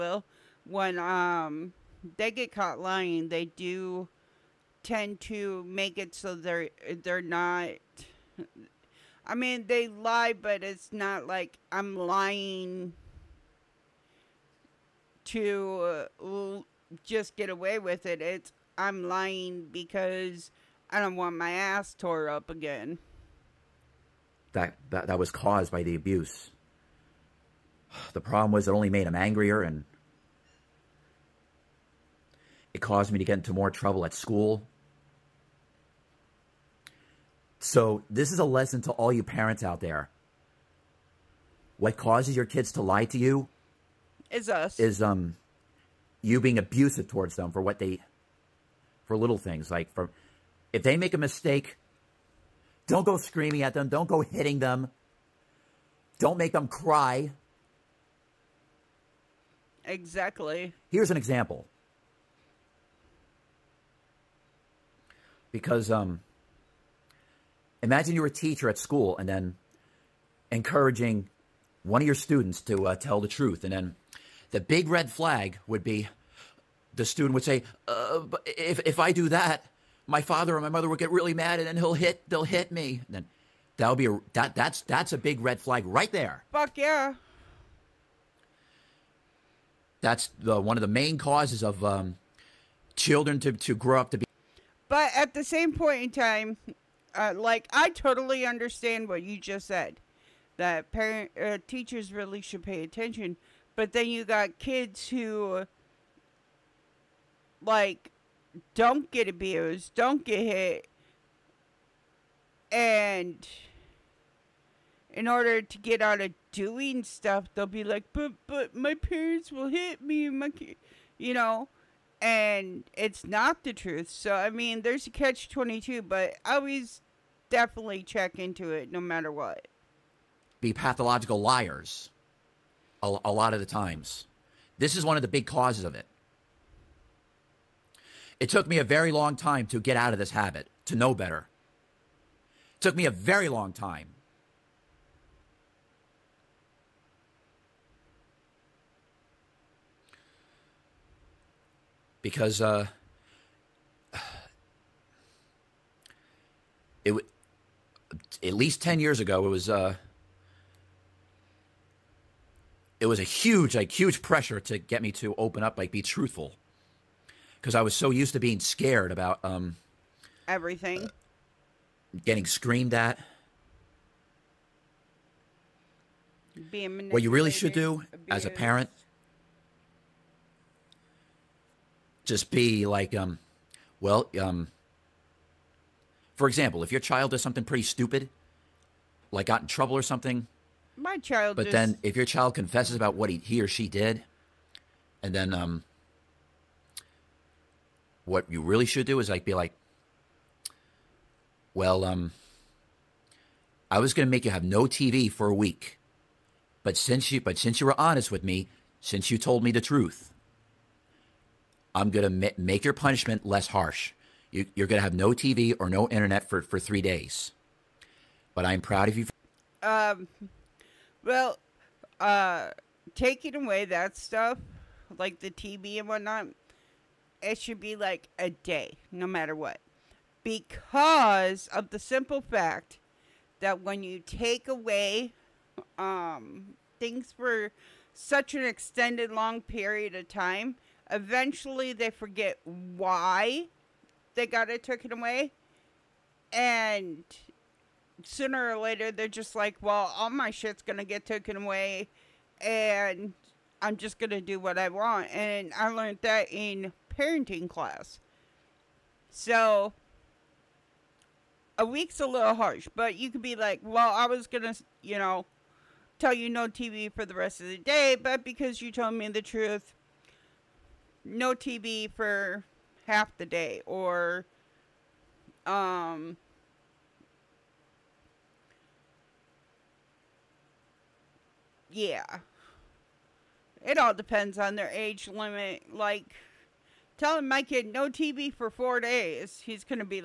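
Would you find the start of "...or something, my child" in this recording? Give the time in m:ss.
3:09.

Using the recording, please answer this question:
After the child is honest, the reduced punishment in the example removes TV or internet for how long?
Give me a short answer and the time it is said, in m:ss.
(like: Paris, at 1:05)
3 days, at 3:36.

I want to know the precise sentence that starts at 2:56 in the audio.
Being what you really should do abused.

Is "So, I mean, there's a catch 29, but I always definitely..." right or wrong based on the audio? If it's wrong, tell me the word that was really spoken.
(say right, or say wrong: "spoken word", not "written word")
wrong: "22", not "29".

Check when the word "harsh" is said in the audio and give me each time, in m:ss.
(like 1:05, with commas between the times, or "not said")
3:33, 4:22.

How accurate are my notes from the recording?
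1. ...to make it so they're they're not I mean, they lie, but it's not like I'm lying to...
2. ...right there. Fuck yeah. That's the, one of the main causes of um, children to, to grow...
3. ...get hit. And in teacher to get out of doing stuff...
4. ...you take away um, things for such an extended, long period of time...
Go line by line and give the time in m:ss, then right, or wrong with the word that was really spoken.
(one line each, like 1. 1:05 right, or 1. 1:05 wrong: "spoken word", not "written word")
1. 0:05 right
2. 1:25 right
3. 1:50 wrong: "order", not "teacher"
4. 3:54 right.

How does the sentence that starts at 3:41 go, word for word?
Well, uh, taking away that stuff, like the TV and whatnot, it should be like a day, no matter what.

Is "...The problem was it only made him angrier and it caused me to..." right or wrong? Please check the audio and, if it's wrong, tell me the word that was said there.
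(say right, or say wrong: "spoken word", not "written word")
right.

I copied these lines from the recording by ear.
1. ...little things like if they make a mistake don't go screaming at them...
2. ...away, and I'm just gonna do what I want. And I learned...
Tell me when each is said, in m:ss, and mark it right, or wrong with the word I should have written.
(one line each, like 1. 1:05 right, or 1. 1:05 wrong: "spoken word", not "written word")
1. 0:49 right
2. 4:11 right.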